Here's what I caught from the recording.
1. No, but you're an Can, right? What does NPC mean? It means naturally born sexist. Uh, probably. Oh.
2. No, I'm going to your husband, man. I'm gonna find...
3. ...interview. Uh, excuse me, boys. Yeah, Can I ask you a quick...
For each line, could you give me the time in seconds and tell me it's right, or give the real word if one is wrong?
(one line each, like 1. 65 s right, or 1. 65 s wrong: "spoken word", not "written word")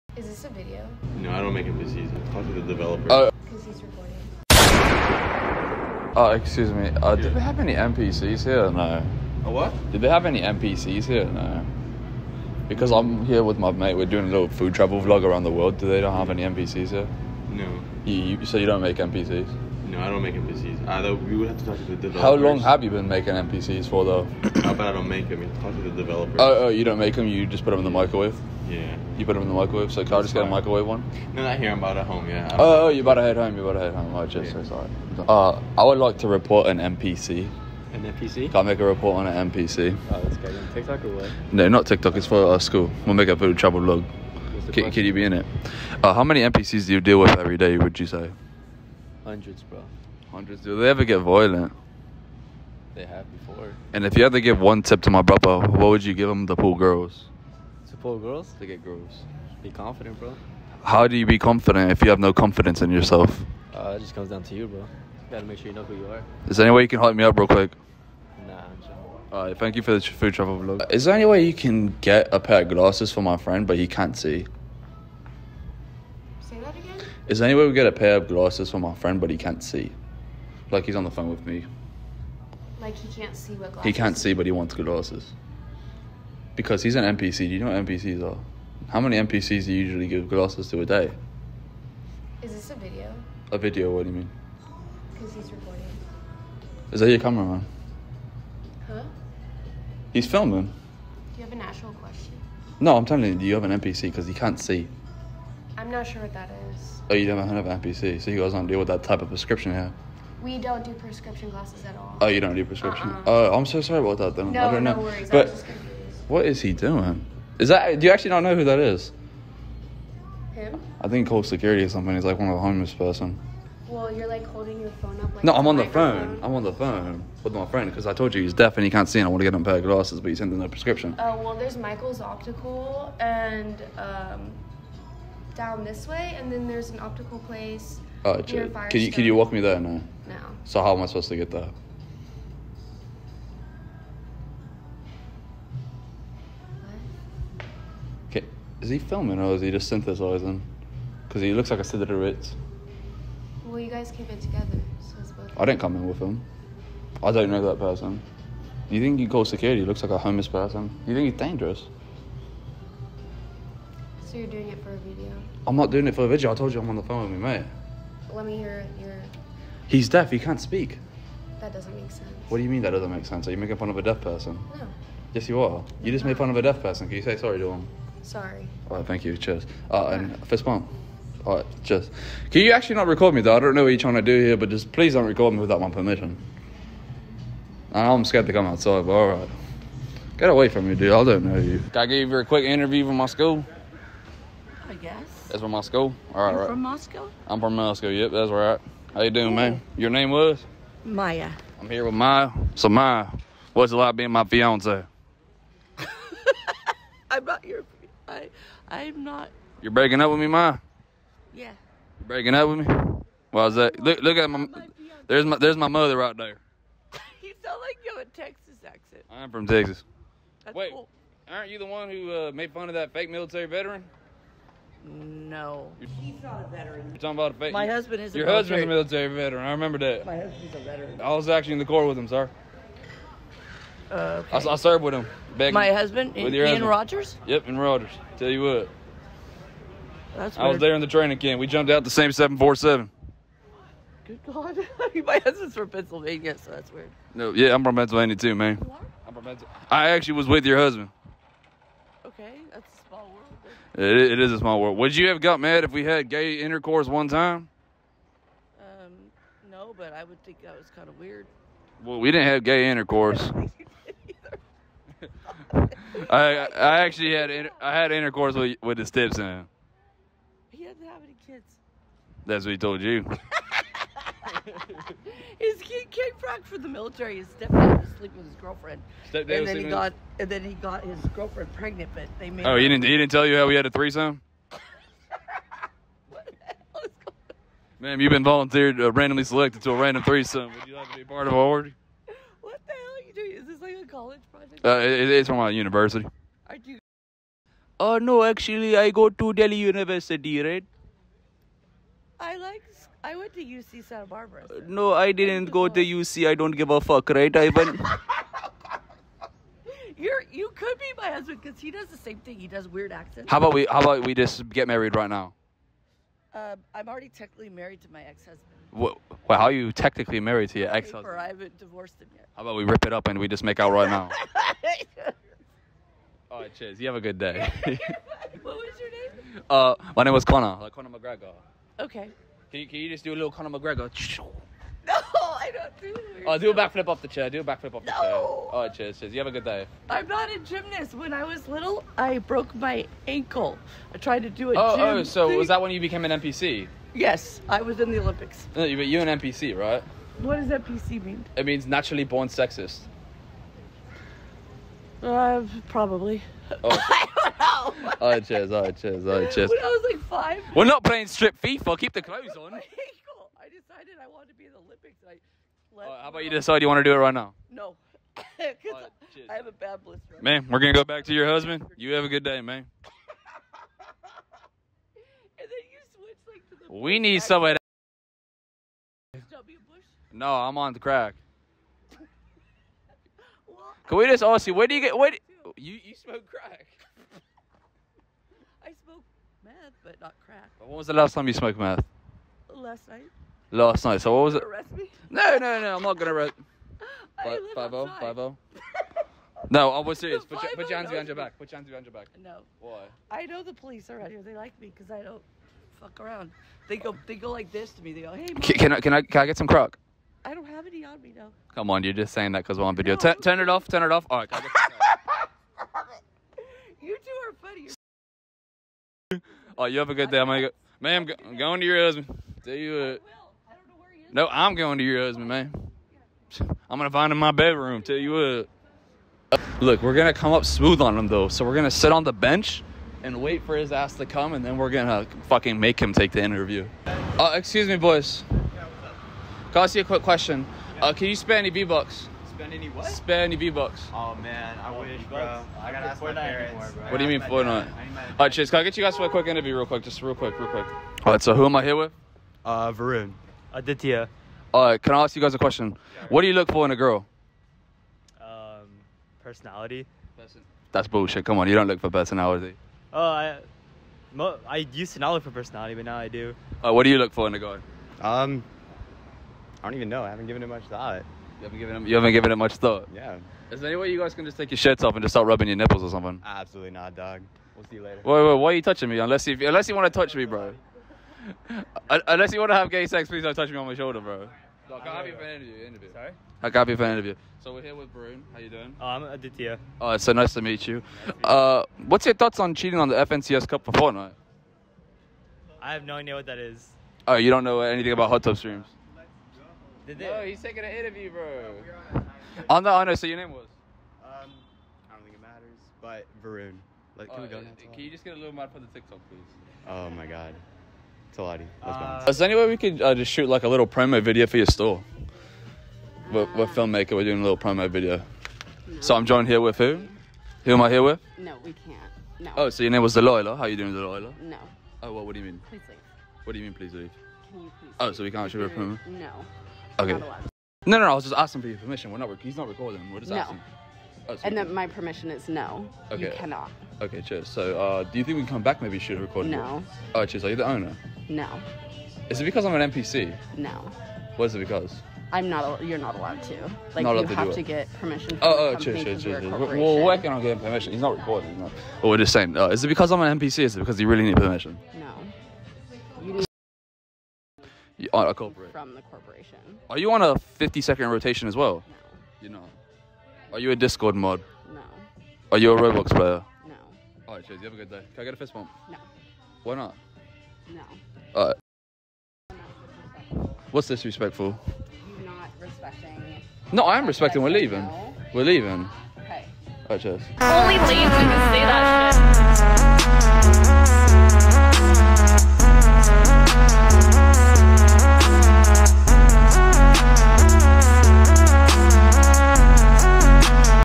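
1. 348 s wrong: "NPC", not "Can"
2. 424 s right
3. 436 s right.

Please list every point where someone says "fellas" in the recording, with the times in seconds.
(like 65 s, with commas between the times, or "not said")
not said.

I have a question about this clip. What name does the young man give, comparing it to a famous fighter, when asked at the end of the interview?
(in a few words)
Connor.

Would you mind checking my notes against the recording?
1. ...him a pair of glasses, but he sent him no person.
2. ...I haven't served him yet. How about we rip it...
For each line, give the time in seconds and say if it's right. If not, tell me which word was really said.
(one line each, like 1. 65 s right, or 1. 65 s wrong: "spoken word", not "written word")
1. 129 s wrong: "prescription", not "person"
2. 321 s wrong: "divorced", not "served".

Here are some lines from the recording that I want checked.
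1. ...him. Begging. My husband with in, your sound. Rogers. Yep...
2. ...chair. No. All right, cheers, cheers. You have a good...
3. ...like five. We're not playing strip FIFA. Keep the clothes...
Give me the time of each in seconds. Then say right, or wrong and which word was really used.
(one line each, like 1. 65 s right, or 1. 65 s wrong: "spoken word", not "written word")
1. 235 s wrong: "husband", not "sound"
2. 338 s right
3. 360 s right.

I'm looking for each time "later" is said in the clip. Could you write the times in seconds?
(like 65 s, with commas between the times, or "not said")
478 s.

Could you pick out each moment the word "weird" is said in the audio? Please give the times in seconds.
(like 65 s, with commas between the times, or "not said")
240 s, 246 s, 261 s, 312 s.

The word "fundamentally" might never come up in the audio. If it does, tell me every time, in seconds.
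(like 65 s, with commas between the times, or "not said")
not said.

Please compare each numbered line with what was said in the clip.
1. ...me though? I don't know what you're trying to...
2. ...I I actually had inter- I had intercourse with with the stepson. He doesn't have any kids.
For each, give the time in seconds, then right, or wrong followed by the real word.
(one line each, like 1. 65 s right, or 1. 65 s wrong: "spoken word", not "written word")
1. 183 s right
2. 265 s right.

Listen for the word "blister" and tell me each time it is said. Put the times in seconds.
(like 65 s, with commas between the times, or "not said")
370 s.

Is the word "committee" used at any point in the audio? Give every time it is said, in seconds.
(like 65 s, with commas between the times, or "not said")
not said.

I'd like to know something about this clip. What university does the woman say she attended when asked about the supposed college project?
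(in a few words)
UC Santa Barbara.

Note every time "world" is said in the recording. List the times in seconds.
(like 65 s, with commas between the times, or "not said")
15 s, 254 s.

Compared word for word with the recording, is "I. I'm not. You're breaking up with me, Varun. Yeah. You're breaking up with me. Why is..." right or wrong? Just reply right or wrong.
wrong.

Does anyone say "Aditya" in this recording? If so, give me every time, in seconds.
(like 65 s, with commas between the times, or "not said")
453 s, 489 s.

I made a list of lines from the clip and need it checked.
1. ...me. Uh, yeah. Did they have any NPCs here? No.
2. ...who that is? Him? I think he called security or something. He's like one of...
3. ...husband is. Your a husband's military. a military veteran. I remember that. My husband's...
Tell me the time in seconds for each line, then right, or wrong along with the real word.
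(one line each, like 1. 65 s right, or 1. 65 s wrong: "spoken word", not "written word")
1. 6 s right
2. 118 s right
3. 227 s right.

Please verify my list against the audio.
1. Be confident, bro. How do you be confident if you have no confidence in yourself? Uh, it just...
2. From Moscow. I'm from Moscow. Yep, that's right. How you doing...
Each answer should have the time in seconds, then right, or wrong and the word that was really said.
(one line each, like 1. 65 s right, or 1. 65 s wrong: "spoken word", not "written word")
1. 59 s right
2. 196 s right.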